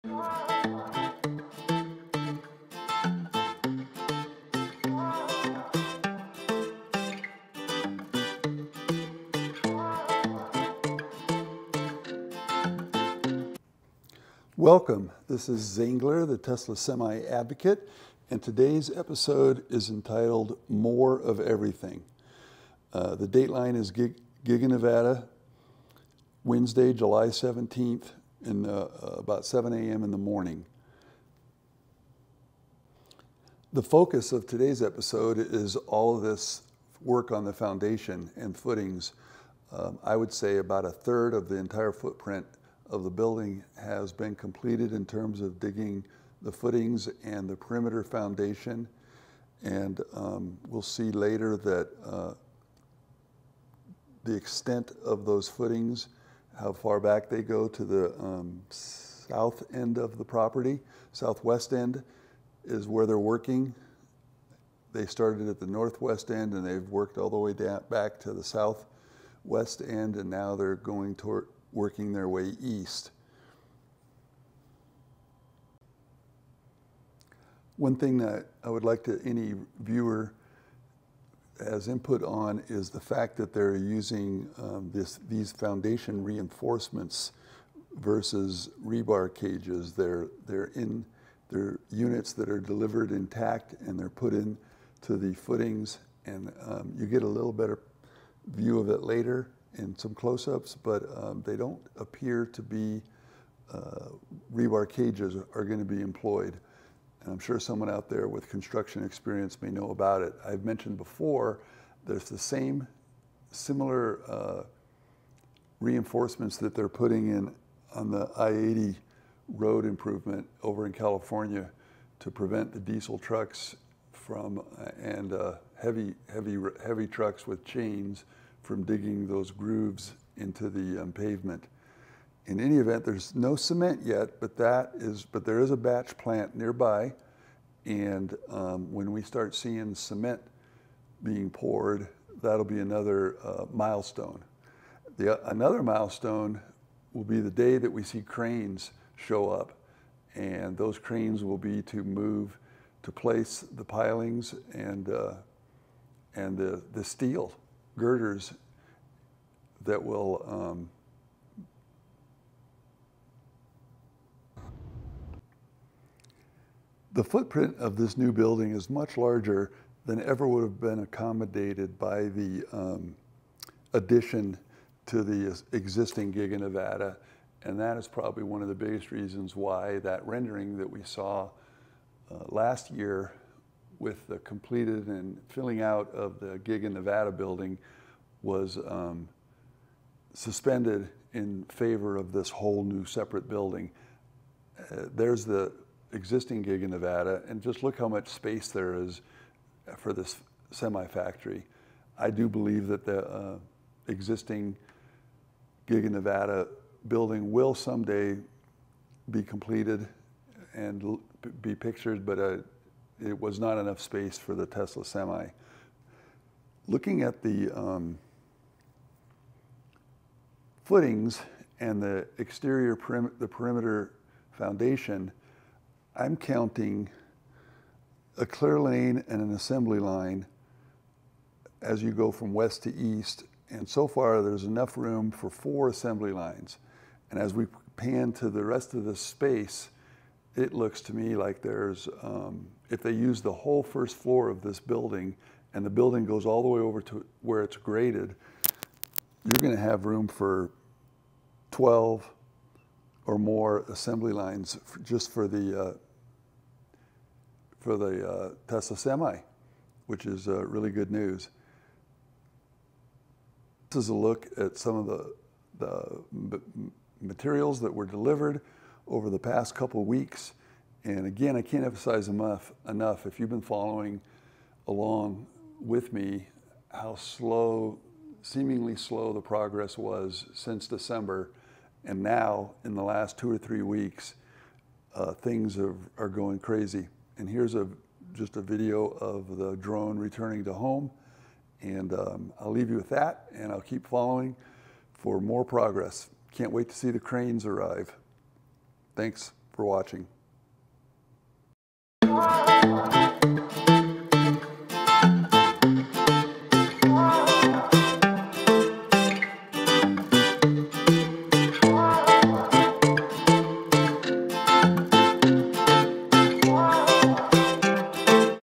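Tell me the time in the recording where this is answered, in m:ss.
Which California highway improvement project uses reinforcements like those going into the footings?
1:58.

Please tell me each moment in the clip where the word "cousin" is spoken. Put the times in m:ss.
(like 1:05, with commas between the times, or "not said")
not said.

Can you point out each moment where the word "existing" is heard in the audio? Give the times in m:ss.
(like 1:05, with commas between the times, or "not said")
2:55, 3:16, 3:24.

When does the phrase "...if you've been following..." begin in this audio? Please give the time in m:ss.
4:33.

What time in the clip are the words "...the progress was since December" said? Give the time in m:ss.
4:39.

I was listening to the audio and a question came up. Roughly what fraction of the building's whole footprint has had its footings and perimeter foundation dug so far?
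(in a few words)
a third.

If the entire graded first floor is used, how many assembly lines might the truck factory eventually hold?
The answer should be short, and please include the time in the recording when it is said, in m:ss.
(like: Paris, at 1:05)
12 or more, at 4:11.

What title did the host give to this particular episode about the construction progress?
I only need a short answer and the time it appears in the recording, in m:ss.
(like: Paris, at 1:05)
More of Everything, at 0:20.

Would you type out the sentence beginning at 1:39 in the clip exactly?
In some close-ups, but um, they don't appear to be uh, rebar cages are going to be employed.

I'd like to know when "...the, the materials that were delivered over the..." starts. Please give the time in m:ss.
4:25.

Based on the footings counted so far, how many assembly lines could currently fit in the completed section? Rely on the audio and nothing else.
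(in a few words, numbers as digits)
4.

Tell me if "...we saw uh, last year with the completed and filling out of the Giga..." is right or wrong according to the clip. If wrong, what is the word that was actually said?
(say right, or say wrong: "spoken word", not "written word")
right.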